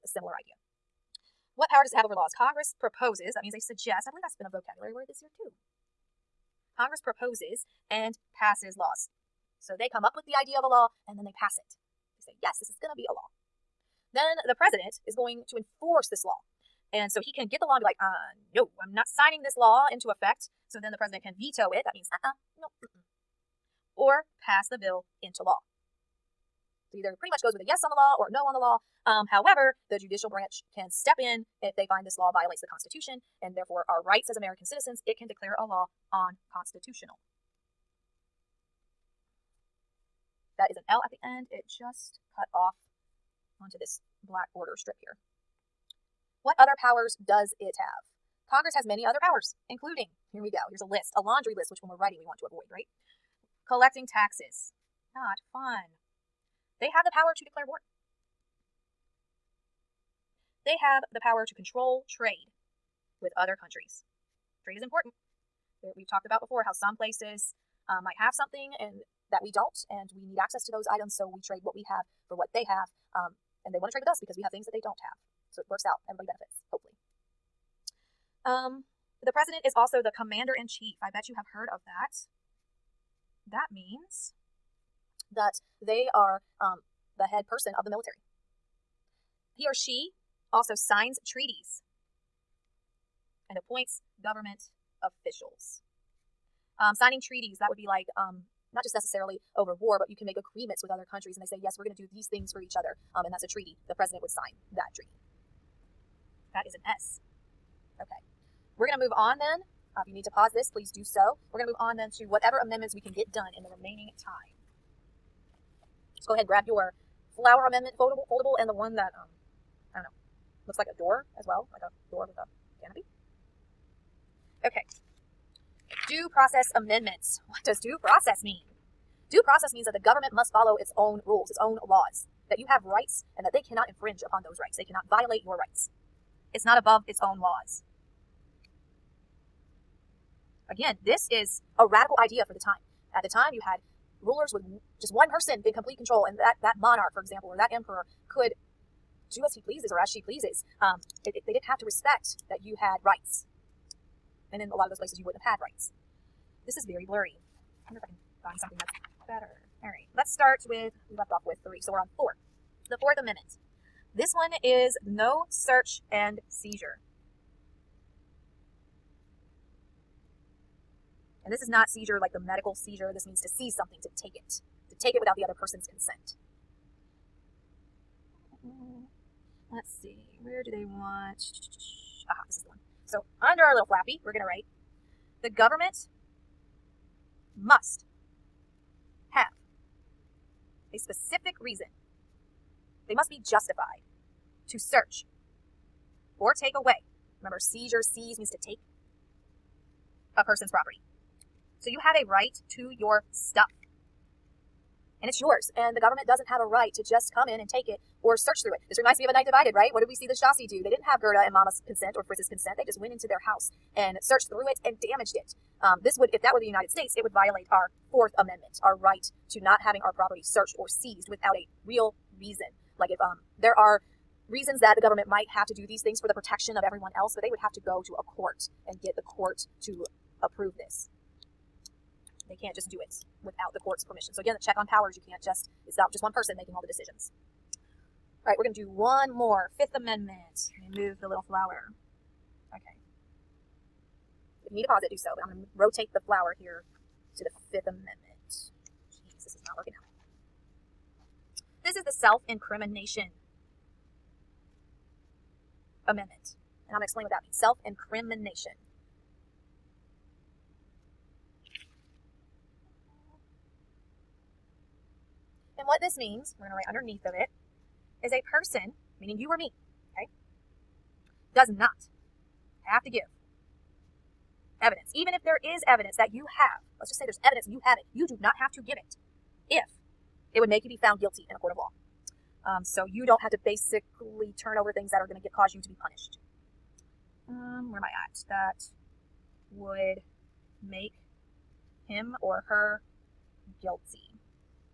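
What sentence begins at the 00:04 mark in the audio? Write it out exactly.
I believe that's been a vocabulary word this year, too.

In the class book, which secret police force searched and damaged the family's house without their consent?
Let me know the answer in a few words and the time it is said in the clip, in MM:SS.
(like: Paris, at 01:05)
Stasi, at 03:30.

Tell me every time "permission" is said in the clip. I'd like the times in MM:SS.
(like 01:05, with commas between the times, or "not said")
03:54.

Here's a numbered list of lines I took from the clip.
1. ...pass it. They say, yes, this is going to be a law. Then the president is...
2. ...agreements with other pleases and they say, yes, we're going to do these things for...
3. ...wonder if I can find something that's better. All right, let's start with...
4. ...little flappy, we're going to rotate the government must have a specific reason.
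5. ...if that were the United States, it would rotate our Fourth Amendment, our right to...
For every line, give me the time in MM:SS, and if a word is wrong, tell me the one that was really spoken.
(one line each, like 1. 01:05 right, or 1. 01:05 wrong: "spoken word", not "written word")
1. 00:11 right
2. 01:40 wrong: "countries", not "pleases"
3. 02:37 right
4. 03:03 wrong: "write", not "rotate"
5. 03:36 wrong: "violate", not "rotate".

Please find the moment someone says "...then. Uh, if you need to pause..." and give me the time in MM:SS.
01:49.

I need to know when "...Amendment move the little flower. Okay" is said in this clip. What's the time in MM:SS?
03:59.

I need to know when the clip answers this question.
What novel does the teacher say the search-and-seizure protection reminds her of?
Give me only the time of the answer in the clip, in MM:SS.
03:29.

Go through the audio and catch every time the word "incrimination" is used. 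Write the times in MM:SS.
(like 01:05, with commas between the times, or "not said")
04:12, 04:17.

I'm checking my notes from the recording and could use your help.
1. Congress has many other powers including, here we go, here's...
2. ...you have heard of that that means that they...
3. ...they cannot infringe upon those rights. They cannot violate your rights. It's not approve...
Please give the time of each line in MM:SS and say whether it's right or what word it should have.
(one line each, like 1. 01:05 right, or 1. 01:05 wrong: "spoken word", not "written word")
1. 00:48 right
2. 01:21 right
3. 02:13 wrong: "above", not "approve".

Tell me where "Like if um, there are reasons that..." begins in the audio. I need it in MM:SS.
03:42.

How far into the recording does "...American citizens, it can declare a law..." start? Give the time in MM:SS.
00:34.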